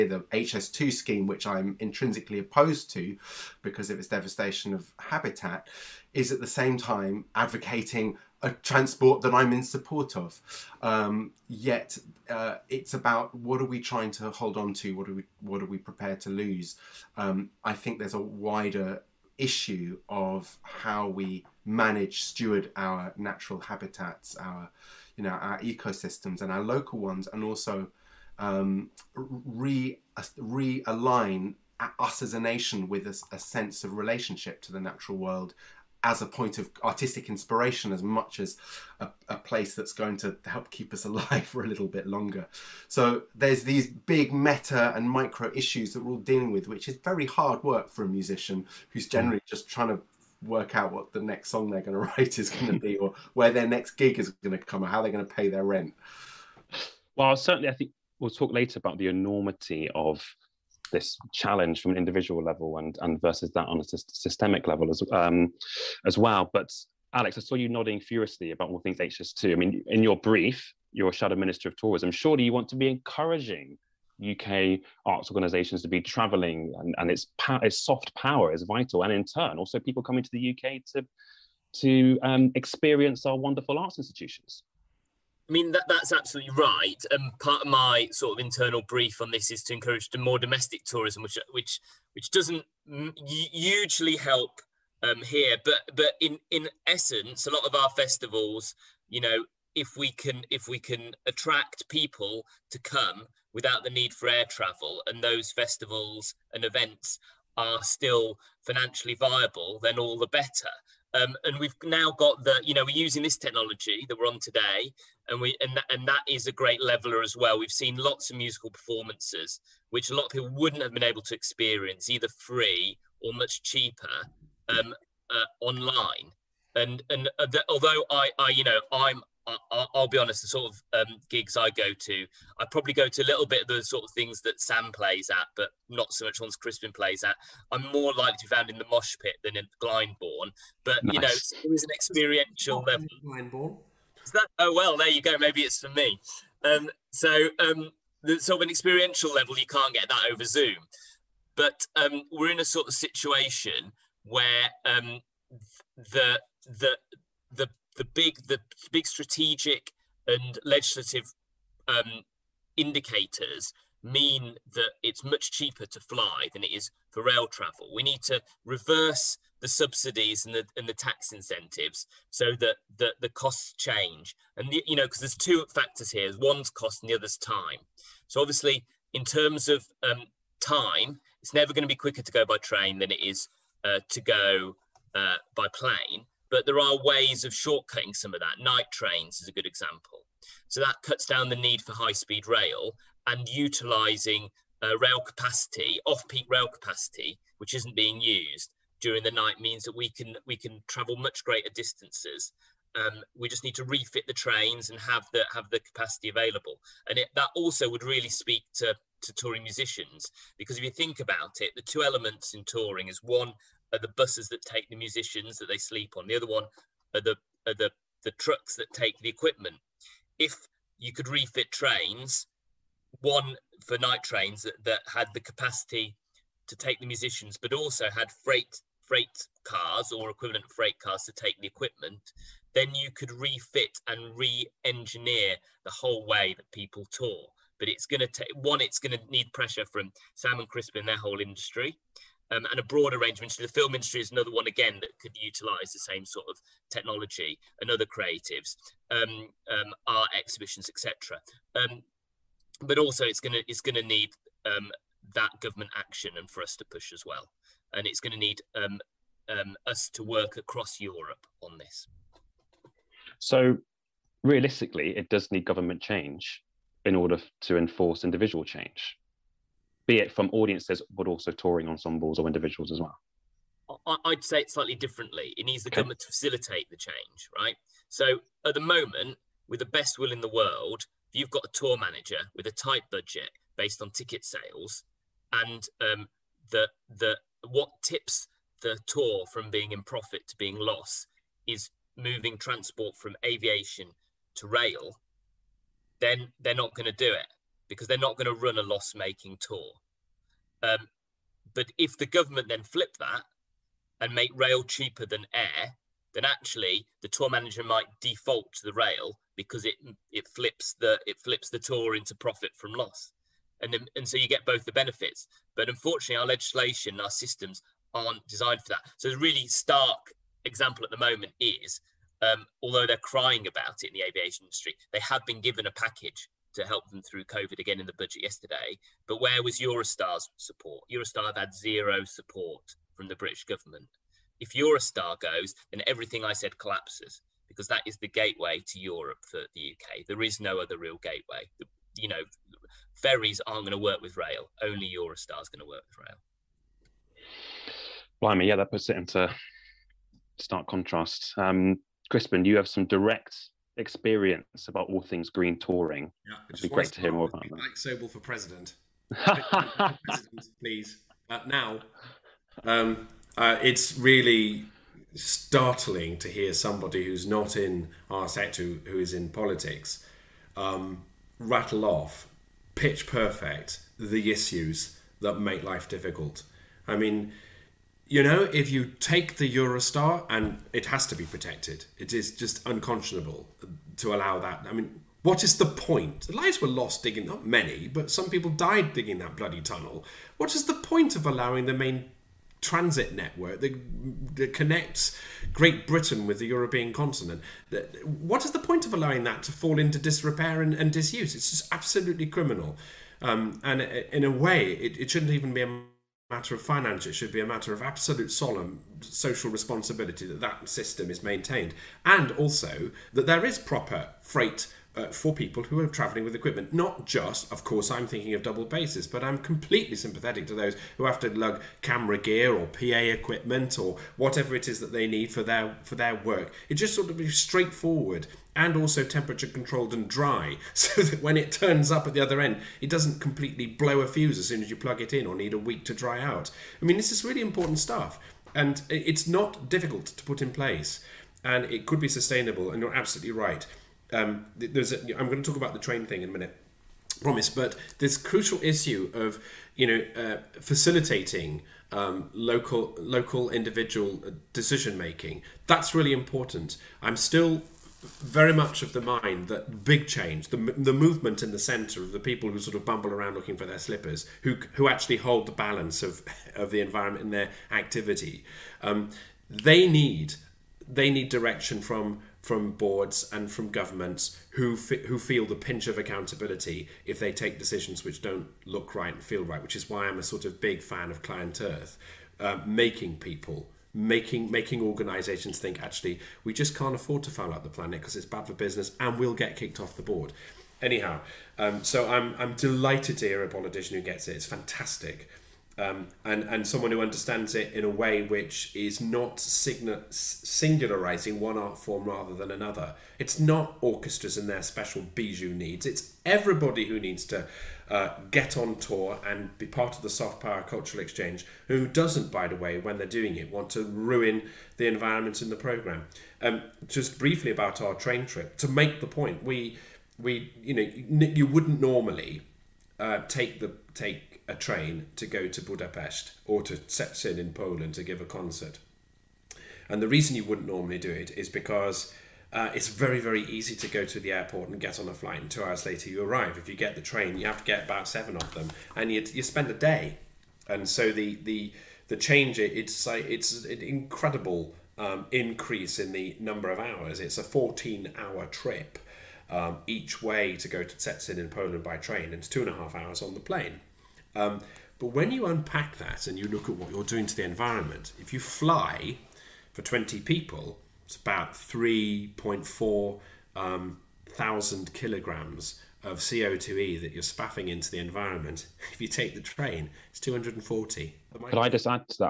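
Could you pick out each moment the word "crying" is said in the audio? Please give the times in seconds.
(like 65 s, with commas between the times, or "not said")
323 s.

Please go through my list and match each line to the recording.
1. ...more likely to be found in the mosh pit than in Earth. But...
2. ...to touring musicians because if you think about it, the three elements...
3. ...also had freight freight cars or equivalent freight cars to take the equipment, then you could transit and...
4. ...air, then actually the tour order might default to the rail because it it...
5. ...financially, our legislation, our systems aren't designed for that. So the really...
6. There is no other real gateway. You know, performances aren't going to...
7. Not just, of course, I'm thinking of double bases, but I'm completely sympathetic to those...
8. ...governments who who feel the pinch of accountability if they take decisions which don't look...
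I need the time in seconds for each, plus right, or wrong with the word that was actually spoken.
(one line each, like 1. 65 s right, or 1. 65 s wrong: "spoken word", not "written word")
1. 137 s wrong: "Glyndebourne", not "Earth"
2. 209 s wrong: "two", not "three"
3. 227 s wrong: "refit", not "transit"
4. 305 s wrong: "manager", not "order"
5. 315 s wrong: "unfortunately", not "financially"
6. 340 s wrong: "ferries", not "performances"
7. 416 s right
8. 473 s right.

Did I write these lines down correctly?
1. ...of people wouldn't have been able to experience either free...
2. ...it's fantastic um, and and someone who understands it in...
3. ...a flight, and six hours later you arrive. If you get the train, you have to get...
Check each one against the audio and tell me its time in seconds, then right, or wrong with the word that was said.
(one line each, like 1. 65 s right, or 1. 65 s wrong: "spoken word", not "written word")
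1. 120 s right
2. 494 s right
3. 535 s wrong: "two", not "six".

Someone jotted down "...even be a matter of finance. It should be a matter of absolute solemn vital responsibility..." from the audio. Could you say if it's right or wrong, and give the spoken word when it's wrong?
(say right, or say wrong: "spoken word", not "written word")
wrong: "social", not "vital".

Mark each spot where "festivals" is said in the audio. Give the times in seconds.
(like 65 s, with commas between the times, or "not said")
97 s, 105 s.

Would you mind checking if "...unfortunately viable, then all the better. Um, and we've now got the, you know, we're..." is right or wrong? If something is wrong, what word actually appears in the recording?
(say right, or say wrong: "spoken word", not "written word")
wrong: "financially", not "unfortunately".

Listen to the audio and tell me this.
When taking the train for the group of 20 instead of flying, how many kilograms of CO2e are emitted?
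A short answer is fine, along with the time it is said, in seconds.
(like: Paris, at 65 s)
240, at 570 s.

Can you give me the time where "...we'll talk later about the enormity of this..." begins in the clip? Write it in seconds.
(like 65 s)
58 s.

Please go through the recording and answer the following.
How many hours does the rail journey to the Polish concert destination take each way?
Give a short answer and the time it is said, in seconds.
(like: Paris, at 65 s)
14, at 547 s.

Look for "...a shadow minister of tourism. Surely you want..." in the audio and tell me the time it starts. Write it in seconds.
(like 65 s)
71 s.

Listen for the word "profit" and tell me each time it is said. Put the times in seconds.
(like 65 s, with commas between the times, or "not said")
290 s, 312 s.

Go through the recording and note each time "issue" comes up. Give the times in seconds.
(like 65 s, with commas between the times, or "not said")
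19 s, 45 s, 374 s, 448 s.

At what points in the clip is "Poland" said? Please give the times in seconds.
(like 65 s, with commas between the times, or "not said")
527 s, 551 s.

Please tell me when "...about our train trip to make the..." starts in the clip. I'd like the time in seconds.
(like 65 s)
517 s.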